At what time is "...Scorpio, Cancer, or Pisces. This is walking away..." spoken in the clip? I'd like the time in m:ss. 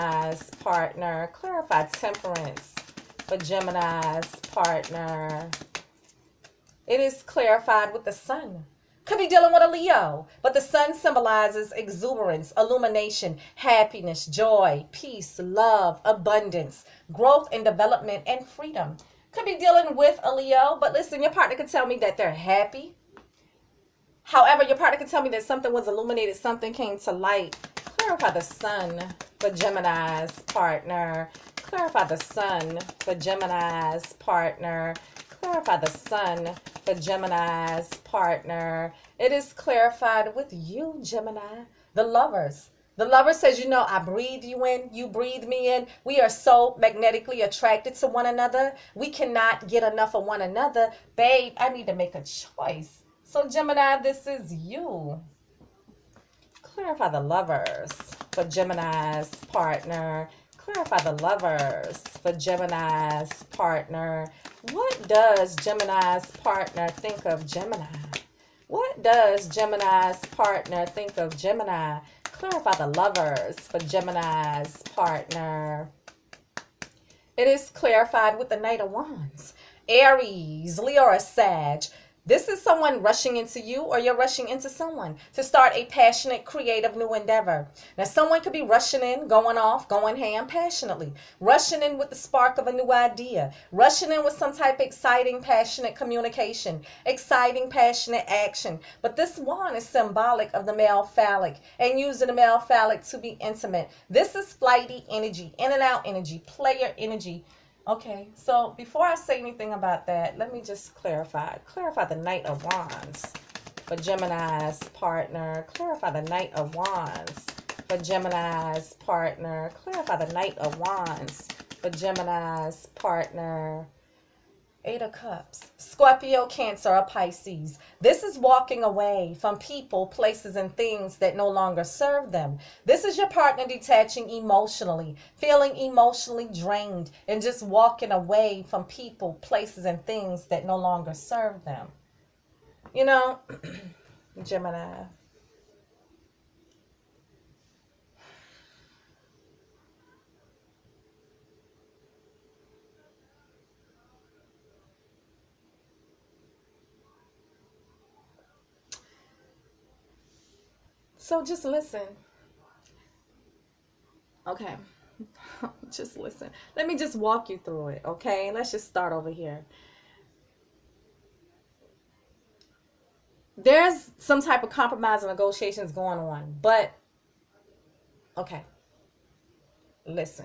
2:05.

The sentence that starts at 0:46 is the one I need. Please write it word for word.
We are so magnetically attracted to one another.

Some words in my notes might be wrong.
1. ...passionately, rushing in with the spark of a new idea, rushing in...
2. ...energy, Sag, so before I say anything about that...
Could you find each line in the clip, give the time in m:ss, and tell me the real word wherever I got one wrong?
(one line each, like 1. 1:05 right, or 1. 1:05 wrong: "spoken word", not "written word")
1. 1:30 right
2. 1:46 wrong: "Okay", not "Sag".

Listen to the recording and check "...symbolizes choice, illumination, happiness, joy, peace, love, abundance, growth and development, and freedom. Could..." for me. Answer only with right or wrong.
wrong.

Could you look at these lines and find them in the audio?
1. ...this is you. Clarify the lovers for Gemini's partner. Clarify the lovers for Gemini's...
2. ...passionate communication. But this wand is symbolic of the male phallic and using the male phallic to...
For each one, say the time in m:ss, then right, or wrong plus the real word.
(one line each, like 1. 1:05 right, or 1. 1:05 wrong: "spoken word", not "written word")
1. 0:54 right
2. 1:37 wrong: "action", not "communication".